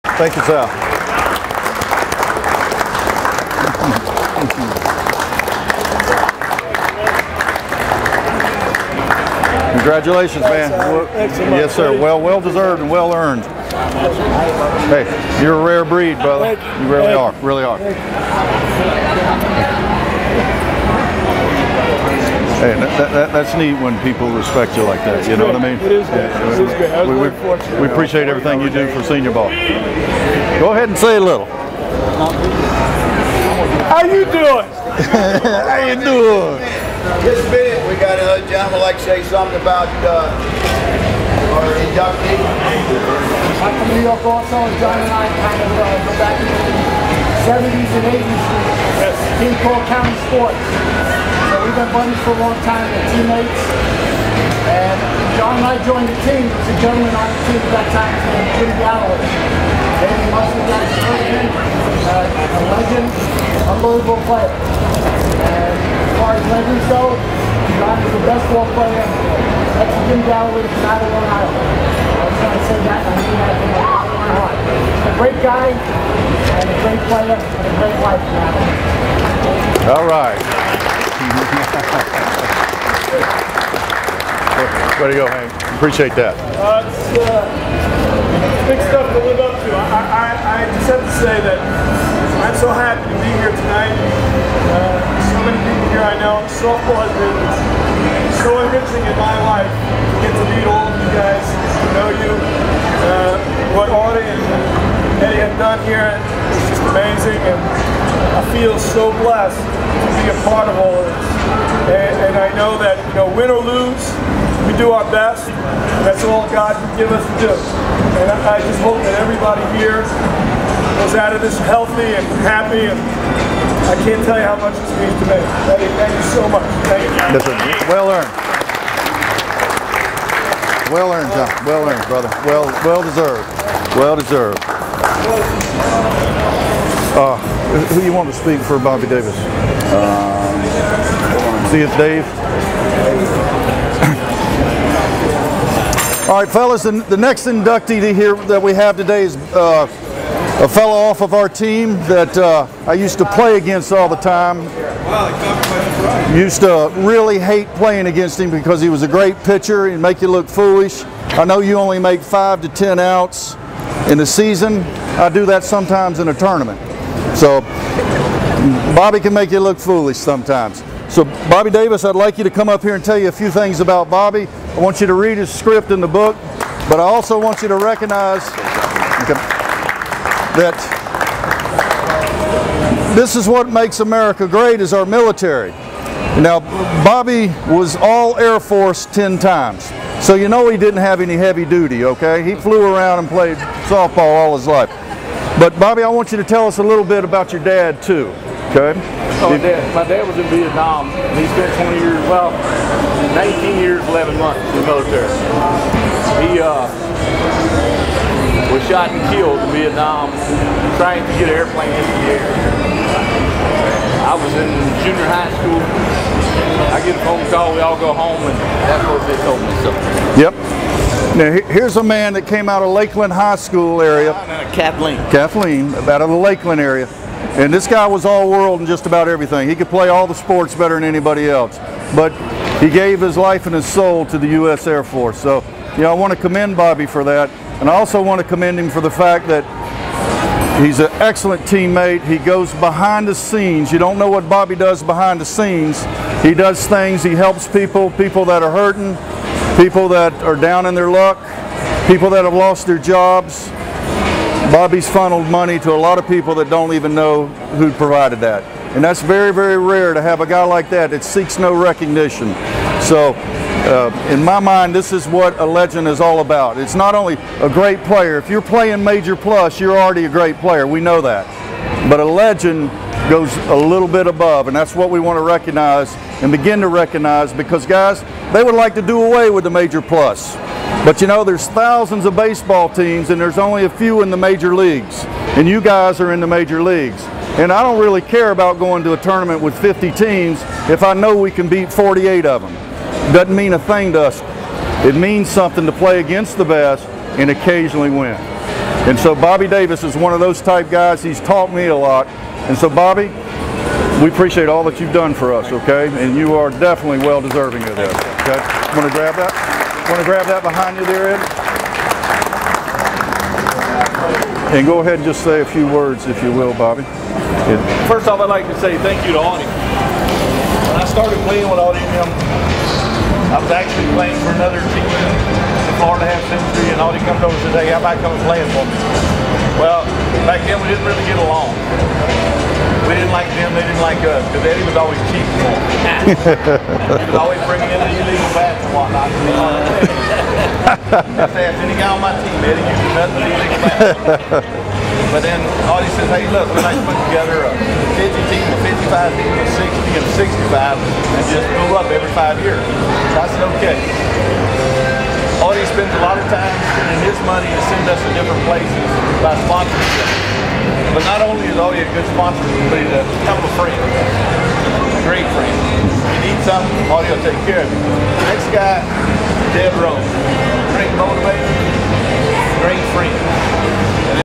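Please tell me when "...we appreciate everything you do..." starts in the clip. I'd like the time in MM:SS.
00:27.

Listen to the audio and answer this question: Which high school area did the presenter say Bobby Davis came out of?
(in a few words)
Lakeland High School.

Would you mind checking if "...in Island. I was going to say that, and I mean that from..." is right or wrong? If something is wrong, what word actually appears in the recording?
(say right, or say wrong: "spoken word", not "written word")
right.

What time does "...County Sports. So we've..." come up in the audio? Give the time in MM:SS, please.
00:49.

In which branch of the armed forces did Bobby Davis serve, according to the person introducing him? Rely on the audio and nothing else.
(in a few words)
U.S. Air Force.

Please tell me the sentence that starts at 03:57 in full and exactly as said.
And I also want to commend him for the fact that he's an excellent teammate.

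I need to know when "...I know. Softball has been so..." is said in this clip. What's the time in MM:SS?
01:36.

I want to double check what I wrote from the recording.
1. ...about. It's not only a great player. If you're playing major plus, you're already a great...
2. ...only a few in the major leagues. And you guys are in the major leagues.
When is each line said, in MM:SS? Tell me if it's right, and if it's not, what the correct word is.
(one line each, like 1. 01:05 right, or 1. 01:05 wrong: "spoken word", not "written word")
1. 04:26 right
2. 04:43 right.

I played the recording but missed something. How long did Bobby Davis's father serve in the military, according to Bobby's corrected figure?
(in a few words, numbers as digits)
19 years, 11 months.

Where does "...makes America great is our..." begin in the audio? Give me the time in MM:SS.
03:03.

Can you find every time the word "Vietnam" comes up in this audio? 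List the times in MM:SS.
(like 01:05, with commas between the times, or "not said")
03:20, 03:29.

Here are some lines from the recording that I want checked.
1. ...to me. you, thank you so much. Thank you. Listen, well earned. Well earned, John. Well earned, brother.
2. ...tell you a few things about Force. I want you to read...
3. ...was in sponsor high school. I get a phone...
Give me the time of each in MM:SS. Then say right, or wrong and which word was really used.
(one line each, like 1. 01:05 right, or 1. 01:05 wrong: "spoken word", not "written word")
1. 02:05 right
2. 02:53 wrong: "Bobby", not "Force"
3. 03:34 wrong: "junior", not "sponsor".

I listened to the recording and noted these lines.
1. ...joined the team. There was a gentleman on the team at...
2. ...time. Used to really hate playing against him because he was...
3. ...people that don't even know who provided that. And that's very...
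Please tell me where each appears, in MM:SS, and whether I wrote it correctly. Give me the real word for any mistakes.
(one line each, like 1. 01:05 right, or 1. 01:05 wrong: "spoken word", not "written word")
1. 00:55 right
2. 02:34 right
3. 04:16 right.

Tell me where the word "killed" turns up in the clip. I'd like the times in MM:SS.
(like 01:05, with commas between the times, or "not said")
03:29.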